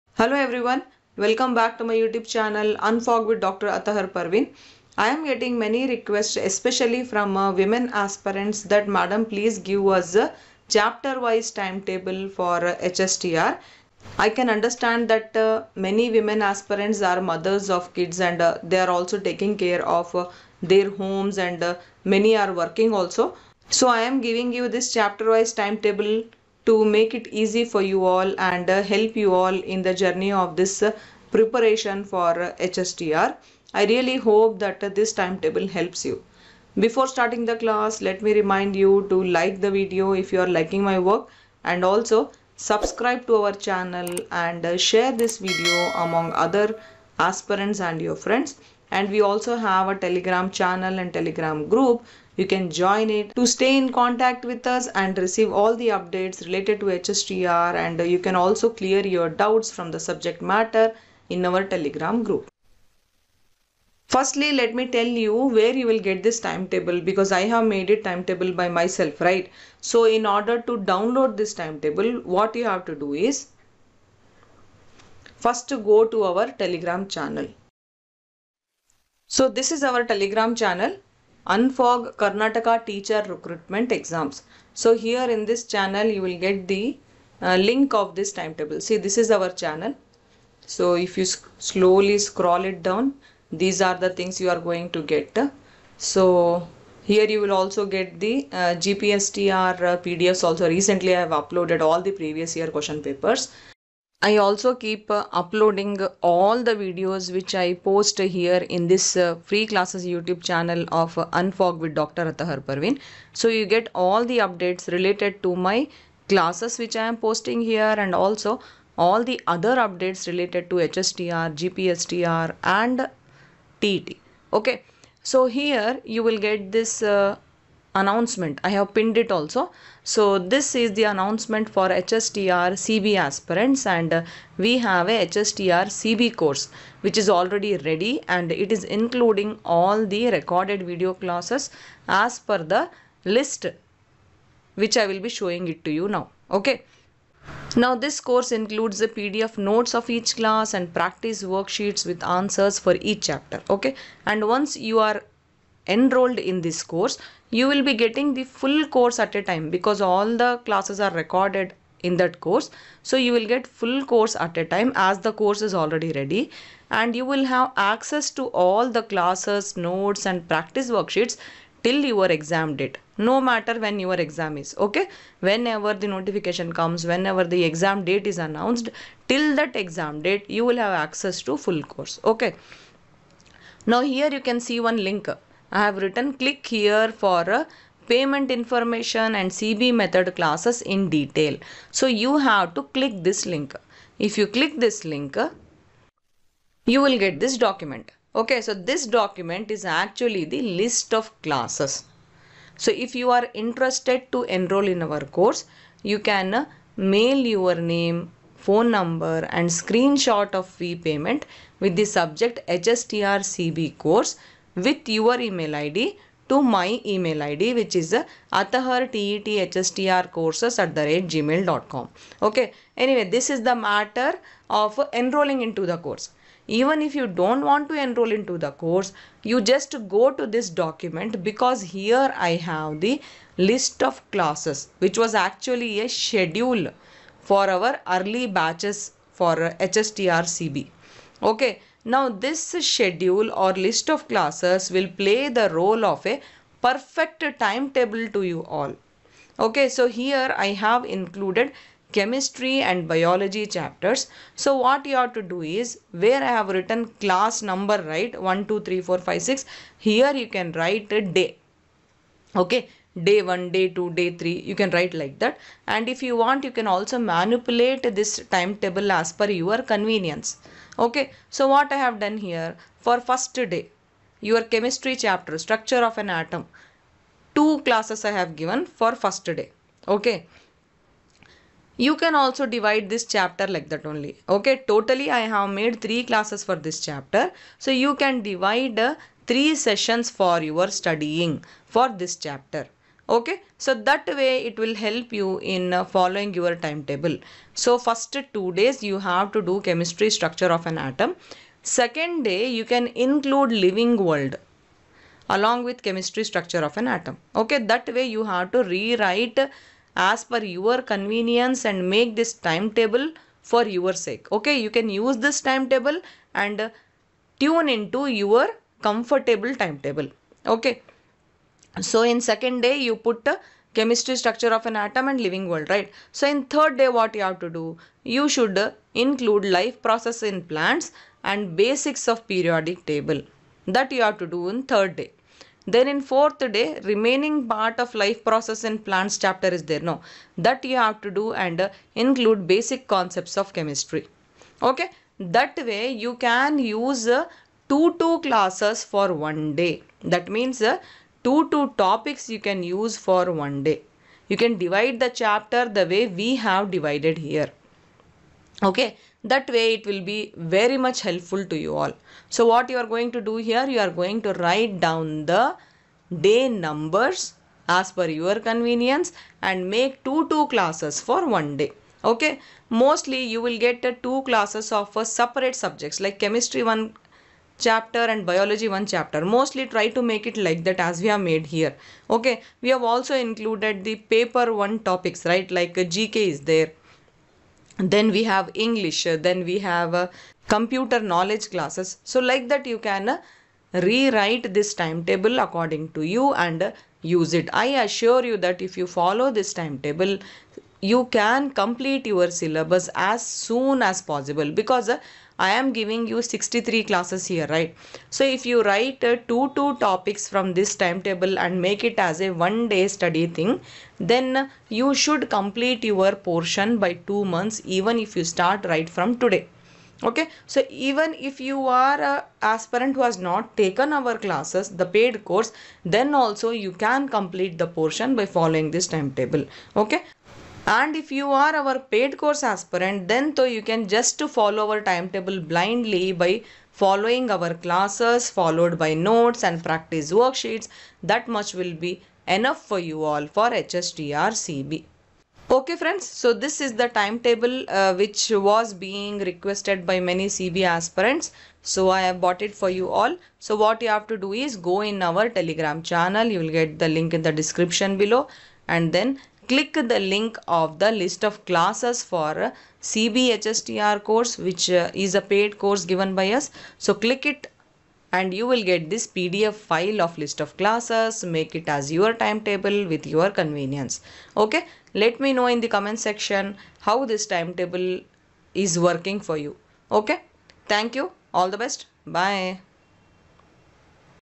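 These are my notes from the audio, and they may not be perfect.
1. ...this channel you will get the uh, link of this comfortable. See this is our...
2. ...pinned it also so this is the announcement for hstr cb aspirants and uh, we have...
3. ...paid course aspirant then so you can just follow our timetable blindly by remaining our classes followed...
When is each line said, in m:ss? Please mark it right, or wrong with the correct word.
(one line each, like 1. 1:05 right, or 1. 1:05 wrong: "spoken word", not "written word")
1. 1:25 wrong: "timetable", not "comfortable"
2. 2:08 right
3. 7:12 wrong: "following", not "remaining".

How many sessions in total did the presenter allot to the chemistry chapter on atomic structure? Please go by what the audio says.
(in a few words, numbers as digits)
3.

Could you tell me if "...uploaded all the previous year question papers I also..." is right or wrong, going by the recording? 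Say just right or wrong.
right.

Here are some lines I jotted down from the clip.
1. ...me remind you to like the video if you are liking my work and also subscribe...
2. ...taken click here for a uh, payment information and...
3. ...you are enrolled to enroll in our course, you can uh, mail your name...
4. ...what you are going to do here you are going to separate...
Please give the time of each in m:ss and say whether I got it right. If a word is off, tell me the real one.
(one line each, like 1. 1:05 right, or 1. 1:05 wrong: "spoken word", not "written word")
1. 0:38 right
2. 3:05 wrong: "written", not "taken"
3. 3:23 wrong: "interested", not "enrolled"
4. 6:02 wrong: "write", not "separate".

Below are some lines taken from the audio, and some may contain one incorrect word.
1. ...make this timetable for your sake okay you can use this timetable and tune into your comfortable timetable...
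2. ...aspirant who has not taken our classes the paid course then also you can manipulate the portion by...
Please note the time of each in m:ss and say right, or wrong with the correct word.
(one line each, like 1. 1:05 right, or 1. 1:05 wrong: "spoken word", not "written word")
1. 5:12 right
2. 7:02 wrong: "complete", not "manipulate".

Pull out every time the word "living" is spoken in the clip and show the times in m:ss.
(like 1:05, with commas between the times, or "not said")
5:03, 5:25.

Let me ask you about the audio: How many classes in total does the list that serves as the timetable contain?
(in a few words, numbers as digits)
63.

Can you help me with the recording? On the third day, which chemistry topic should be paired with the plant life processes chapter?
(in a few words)
Basics of periodic table.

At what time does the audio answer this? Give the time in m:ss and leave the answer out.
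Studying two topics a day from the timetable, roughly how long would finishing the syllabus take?
6:57.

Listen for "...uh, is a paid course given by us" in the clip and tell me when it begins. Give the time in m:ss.
7:44.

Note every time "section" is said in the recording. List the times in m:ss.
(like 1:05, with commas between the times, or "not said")
7:56.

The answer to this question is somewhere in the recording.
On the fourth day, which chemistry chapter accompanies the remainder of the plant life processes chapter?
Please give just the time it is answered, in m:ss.
5:42.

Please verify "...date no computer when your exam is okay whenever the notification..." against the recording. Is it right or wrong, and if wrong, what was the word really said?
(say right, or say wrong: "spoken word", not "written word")
wrong: "matter", not "computer".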